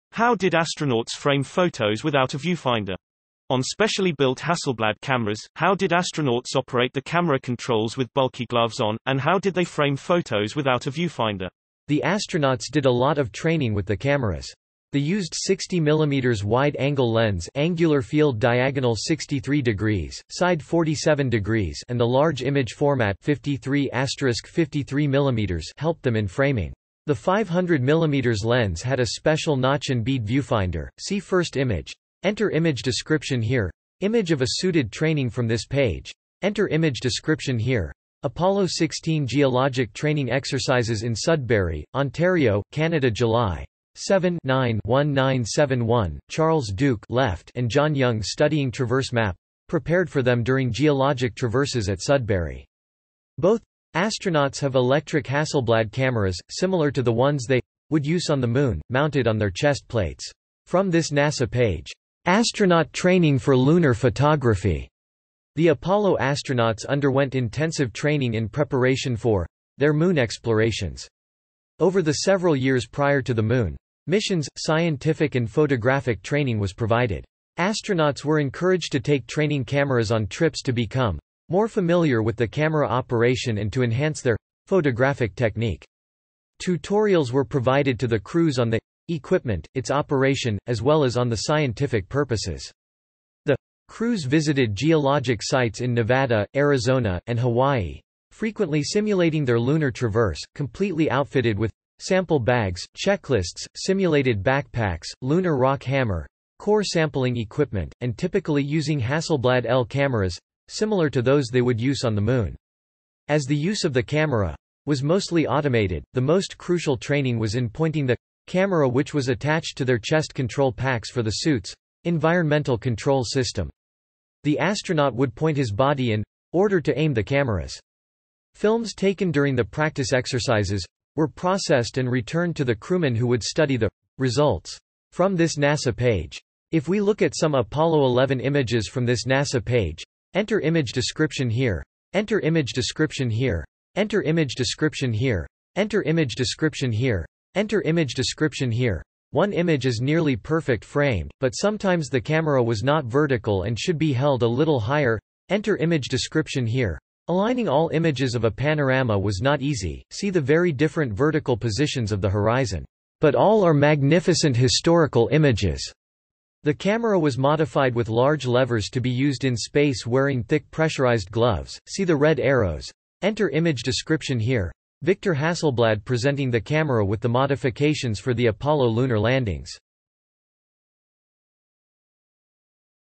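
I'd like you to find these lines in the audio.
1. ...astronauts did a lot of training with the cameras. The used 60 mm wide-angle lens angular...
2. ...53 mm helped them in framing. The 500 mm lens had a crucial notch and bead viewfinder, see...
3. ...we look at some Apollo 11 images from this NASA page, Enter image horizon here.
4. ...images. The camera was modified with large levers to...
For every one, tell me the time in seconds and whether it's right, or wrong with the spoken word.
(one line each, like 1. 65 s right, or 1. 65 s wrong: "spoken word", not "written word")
1. 12 s right
2. 24 s wrong: "special", not "crucial"
3. 136 s wrong: "description", not "horizon"
4. 165 s right.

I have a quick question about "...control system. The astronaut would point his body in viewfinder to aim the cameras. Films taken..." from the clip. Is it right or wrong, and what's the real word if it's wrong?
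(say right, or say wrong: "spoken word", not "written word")
wrong: "order", not "viewfinder".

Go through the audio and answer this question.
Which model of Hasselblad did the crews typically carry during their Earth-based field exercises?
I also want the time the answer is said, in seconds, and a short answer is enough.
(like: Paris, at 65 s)
Hasselblad EL, at 109 s.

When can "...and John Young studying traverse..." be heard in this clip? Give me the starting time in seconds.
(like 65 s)
47 s.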